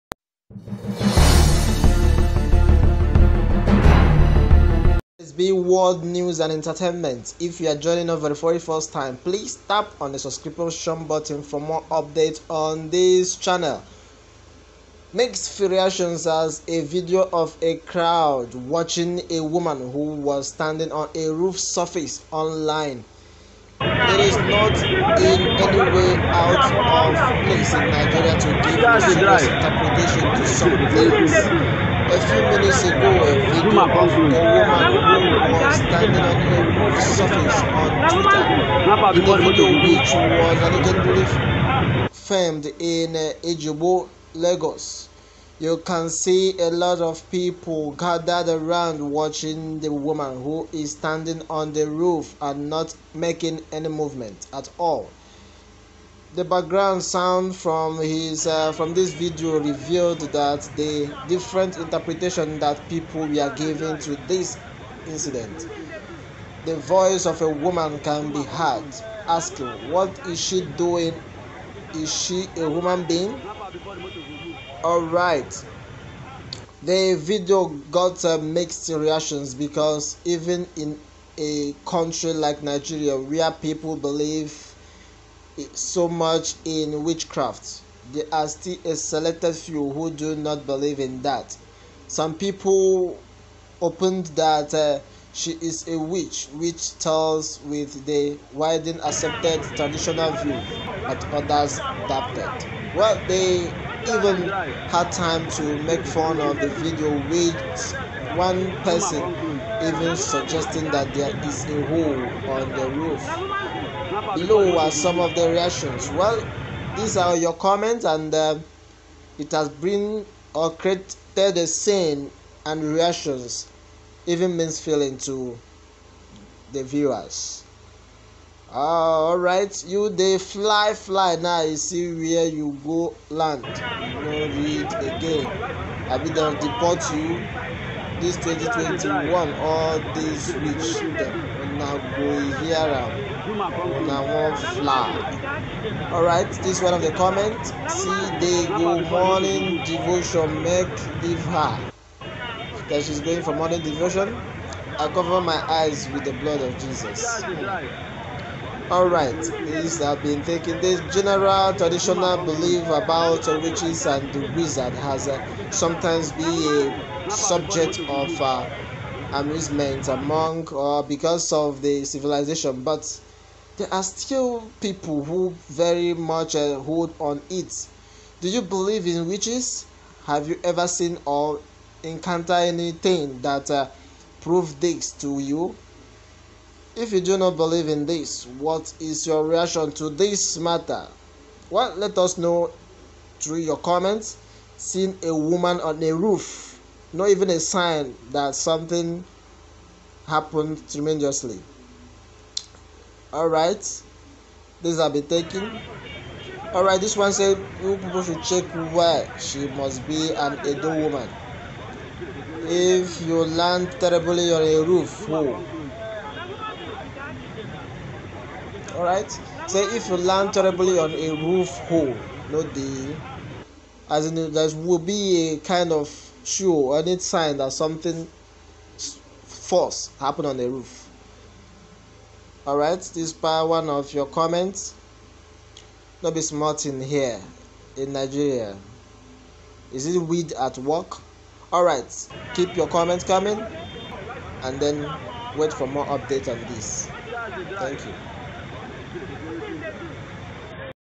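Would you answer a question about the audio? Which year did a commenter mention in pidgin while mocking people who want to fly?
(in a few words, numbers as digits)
2021.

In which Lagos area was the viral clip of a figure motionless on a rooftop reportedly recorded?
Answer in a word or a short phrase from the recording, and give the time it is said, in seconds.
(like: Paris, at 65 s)
Ejibo, at 43 s.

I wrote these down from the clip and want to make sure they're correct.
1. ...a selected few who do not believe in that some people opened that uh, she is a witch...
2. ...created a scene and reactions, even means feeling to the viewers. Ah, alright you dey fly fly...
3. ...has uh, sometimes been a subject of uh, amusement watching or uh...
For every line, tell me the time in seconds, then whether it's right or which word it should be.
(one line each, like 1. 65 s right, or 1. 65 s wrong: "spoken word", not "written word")
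1. 88 s right
2. 120 s right
3. 164 s wrong: "among", not "watching".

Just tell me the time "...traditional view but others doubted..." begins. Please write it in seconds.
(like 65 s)
99 s.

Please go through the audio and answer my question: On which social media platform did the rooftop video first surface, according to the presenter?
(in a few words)
Twitter.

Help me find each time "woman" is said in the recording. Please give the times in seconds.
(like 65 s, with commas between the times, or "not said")
19 s, 34 s, 49 s, 67 s, 195 s, 210 s.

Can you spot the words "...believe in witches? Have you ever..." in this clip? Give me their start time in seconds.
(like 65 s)
178 s.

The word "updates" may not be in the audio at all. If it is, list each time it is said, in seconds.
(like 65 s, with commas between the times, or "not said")
11 s, 246 s.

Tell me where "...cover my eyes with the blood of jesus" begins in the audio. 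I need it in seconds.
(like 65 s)
155 s.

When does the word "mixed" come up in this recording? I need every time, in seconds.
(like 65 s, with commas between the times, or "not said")
15 s, 78 s.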